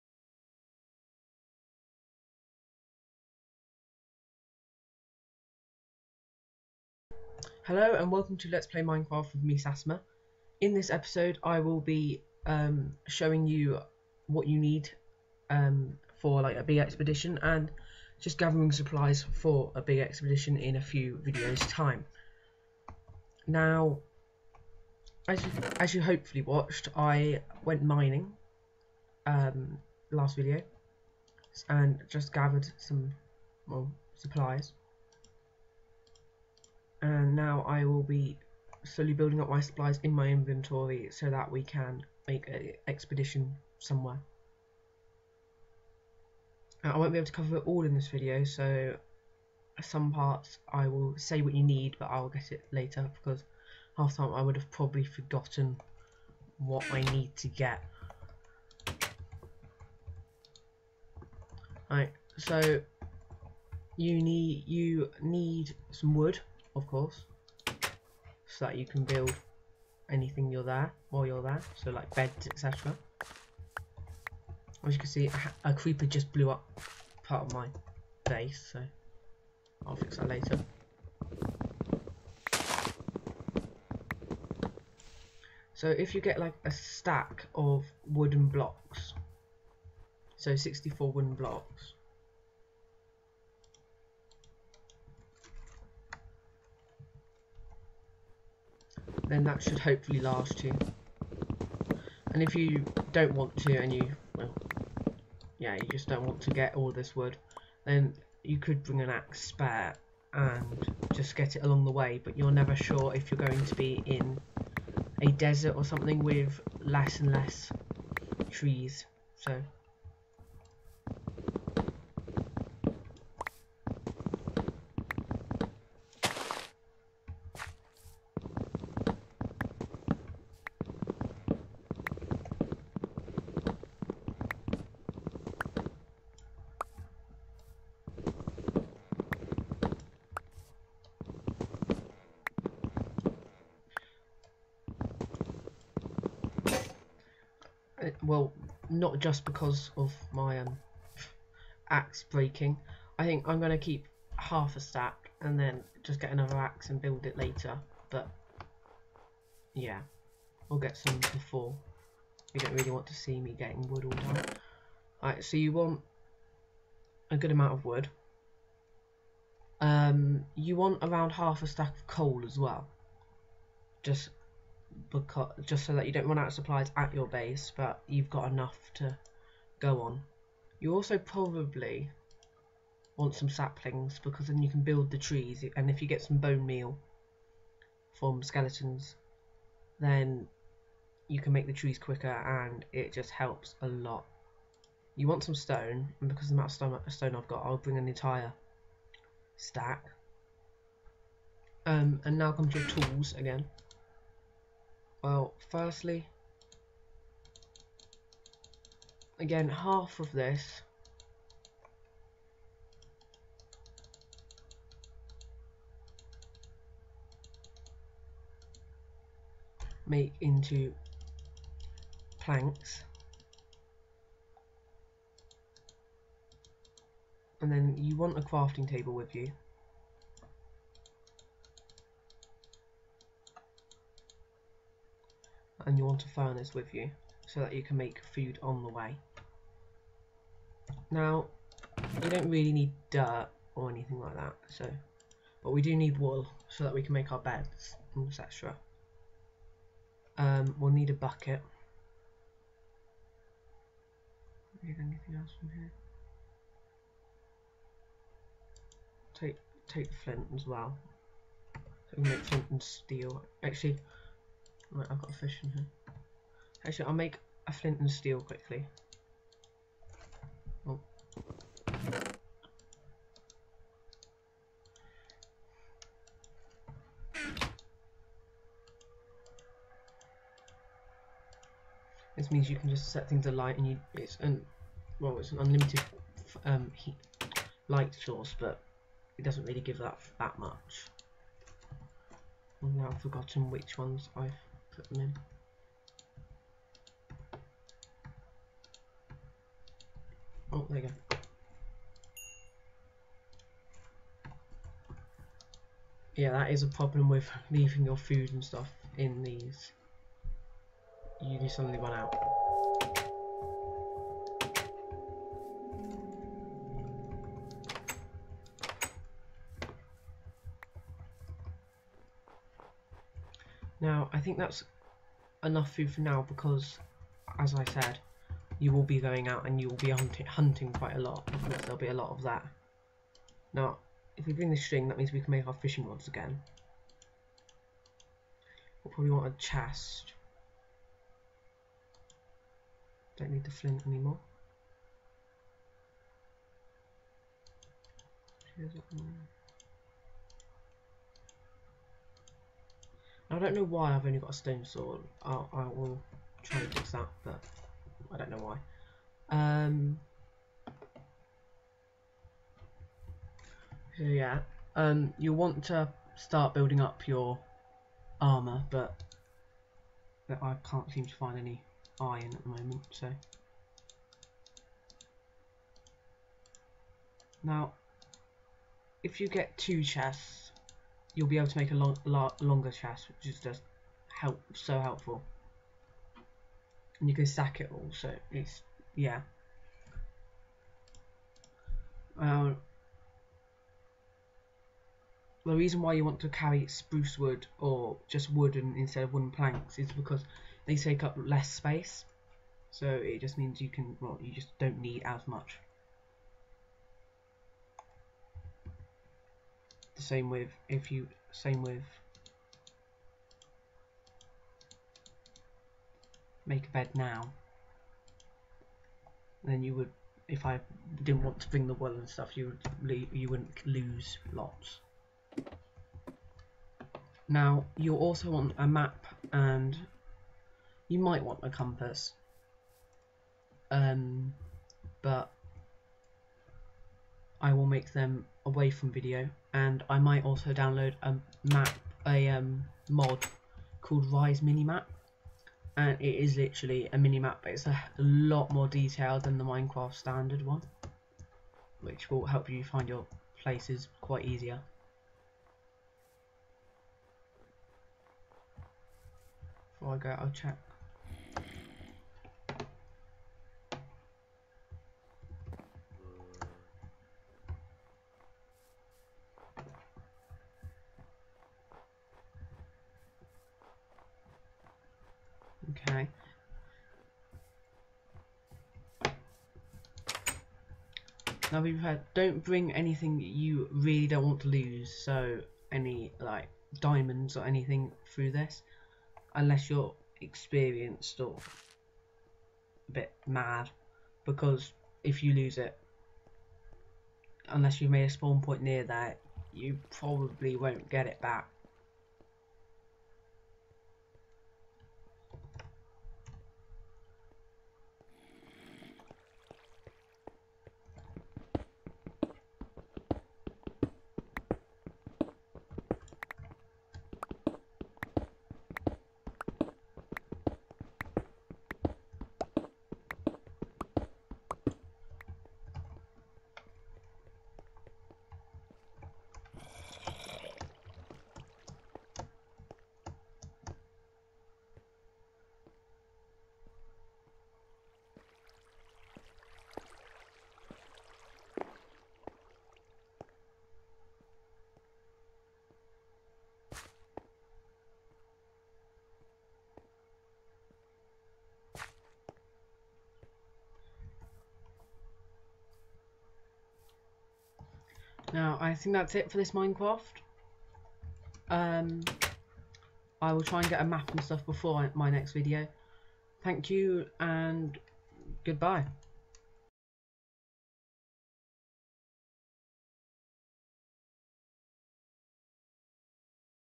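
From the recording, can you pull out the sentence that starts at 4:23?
Actually, Right, I've got a fish in here.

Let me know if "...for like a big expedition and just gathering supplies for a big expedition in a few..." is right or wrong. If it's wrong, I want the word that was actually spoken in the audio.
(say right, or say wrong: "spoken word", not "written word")
right.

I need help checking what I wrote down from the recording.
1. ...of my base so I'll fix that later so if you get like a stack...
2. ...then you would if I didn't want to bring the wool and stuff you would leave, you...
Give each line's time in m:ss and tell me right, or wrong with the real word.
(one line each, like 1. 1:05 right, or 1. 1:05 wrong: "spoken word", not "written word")
1. 1:17 right
2. 6:59 right.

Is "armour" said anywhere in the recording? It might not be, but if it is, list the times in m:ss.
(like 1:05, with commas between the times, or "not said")
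6:08.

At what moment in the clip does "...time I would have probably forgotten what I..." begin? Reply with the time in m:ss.
0:54.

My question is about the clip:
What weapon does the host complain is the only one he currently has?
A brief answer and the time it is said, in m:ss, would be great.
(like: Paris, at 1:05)
stone sword, at 5:54.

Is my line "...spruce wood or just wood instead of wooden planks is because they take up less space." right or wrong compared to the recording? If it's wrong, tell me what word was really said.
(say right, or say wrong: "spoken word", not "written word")
right.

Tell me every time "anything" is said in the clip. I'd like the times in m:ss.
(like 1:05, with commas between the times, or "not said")
1:10, 4:03, 4:14, 8:02, 8:07.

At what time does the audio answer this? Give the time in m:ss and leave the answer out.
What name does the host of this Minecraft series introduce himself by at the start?
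0:09.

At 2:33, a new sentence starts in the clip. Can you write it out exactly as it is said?
I think I'm going to keep half a stack and then just get another axe and build it later.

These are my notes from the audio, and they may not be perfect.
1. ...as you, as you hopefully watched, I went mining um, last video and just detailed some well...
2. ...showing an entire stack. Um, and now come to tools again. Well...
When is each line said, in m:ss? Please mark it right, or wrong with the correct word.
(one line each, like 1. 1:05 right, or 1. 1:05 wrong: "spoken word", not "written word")
1. 0:25 wrong: "gathered", not "detailed"
2. 3:17 wrong: "bring", not "showing".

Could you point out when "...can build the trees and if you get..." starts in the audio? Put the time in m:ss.
3:04.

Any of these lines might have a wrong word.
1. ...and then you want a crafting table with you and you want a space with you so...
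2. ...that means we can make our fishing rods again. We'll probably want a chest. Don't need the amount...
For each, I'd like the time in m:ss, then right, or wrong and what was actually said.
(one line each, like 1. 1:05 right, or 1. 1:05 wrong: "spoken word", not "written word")
1. 3:47 wrong: "furnace", not "space"
2. 5:35 wrong: "flint", not "amount".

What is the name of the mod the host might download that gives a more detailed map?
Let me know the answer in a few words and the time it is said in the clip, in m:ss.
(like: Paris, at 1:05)
Rise Minimap, at 7:24.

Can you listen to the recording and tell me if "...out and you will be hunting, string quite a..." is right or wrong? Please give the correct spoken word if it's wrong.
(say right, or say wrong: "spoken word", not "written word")
wrong: "hunting", not "string".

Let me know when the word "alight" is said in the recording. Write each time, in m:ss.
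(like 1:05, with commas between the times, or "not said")
4:43.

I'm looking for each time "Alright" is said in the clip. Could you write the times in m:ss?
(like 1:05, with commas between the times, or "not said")
1:01, 2:45.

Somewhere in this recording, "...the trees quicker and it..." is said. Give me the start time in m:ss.
3:11.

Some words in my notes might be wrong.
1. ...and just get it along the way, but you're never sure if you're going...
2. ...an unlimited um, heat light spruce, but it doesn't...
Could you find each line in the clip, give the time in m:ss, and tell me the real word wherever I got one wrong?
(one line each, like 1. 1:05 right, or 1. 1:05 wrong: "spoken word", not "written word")
1. 1:50 right
2. 4:45 wrong: "source", not "spruce".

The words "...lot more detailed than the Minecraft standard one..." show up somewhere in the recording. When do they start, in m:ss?
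7:28.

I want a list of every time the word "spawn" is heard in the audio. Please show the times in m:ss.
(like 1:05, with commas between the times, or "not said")
8:18.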